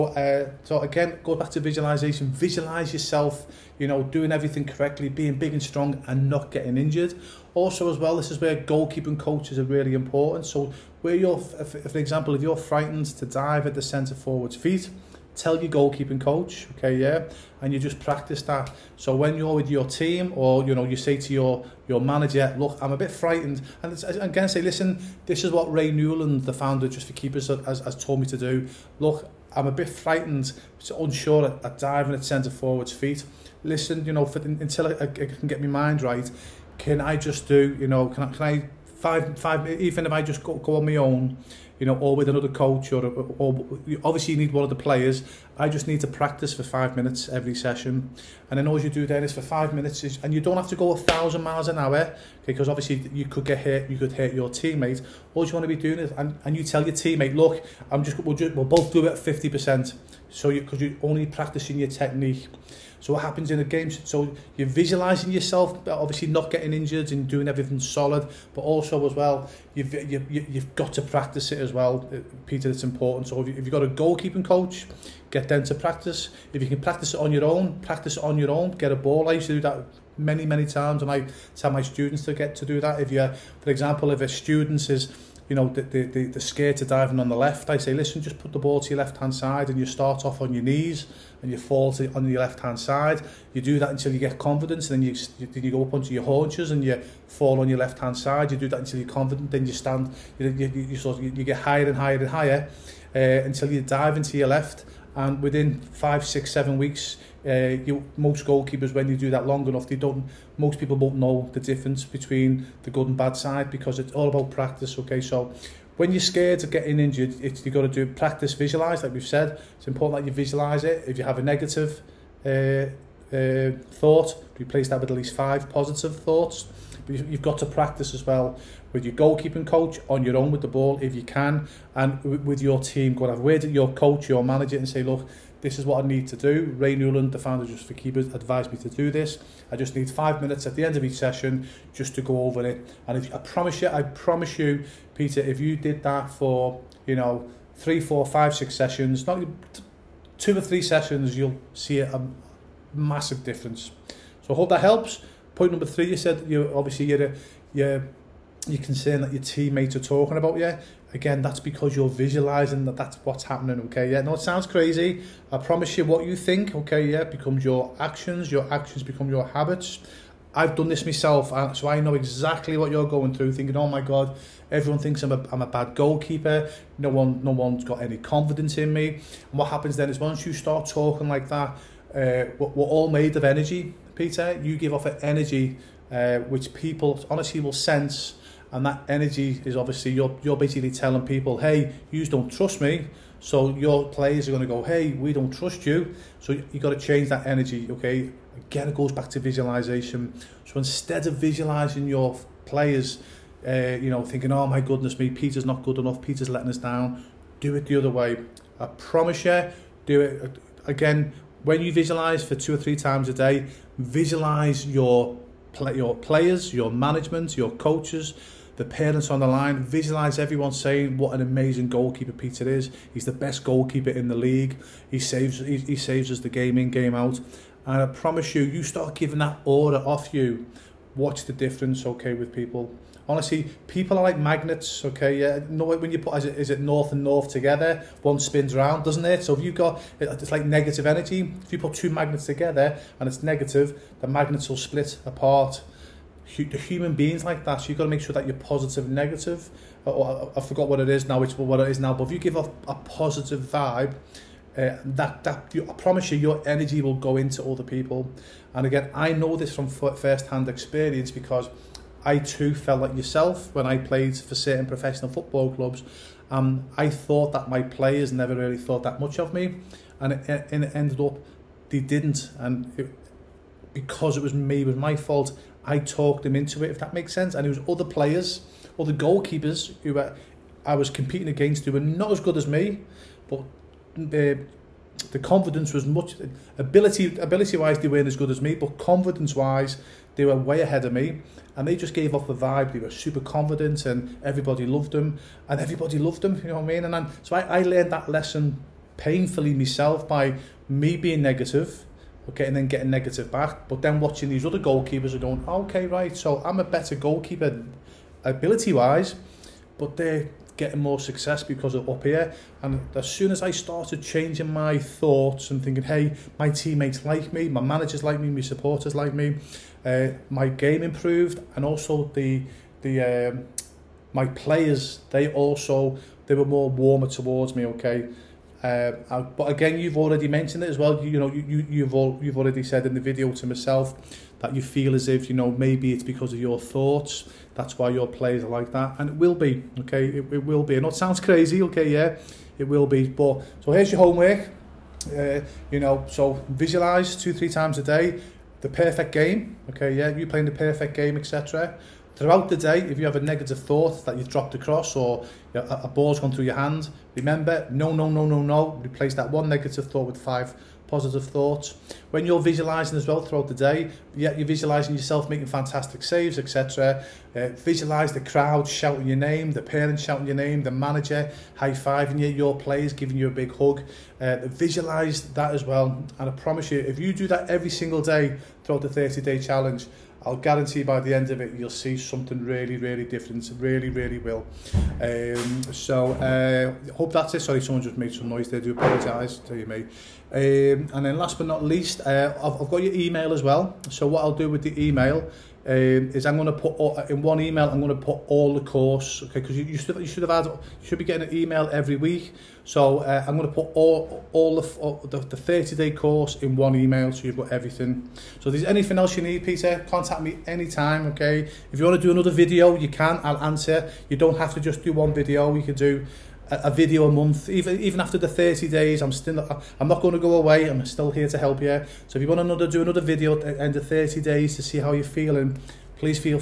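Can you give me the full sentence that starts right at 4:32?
And it, because it was me, it was my fault.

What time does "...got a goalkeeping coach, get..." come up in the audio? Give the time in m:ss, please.
1:13.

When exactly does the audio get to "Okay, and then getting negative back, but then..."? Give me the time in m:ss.
5:02.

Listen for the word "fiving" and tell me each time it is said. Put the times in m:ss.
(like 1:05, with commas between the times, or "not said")
6:11.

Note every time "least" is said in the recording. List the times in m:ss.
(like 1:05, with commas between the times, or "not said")
2:05, 6:31.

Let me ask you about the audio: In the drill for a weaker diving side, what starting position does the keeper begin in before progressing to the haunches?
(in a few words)
On your knees.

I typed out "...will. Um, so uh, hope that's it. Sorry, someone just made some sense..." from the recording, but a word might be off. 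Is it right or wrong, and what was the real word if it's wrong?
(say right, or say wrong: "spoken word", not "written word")
wrong: "noise", not "sense".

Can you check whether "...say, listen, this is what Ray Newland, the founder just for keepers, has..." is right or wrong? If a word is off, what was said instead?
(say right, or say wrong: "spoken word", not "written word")
right.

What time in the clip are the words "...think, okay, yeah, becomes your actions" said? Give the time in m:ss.
2:46.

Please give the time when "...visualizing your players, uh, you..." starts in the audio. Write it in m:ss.
3:21.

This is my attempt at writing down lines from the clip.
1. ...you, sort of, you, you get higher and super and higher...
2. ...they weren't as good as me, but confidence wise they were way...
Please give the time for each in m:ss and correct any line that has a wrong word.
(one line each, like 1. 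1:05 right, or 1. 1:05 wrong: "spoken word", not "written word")
1. 1:40 wrong: "higher", not "super"
2. 4:47 right.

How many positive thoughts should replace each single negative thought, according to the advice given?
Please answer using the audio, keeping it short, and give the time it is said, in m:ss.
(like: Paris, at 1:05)
5, at 2:05.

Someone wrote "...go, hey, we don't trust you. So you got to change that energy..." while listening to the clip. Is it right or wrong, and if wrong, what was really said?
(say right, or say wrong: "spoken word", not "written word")
right.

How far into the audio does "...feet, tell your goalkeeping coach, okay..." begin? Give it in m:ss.
0:14.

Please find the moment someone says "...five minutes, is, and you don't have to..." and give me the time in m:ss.
0:49.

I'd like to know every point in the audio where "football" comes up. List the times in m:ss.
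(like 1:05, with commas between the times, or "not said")
4:25.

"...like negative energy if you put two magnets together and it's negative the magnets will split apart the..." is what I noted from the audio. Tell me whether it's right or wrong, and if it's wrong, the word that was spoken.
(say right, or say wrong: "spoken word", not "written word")
right.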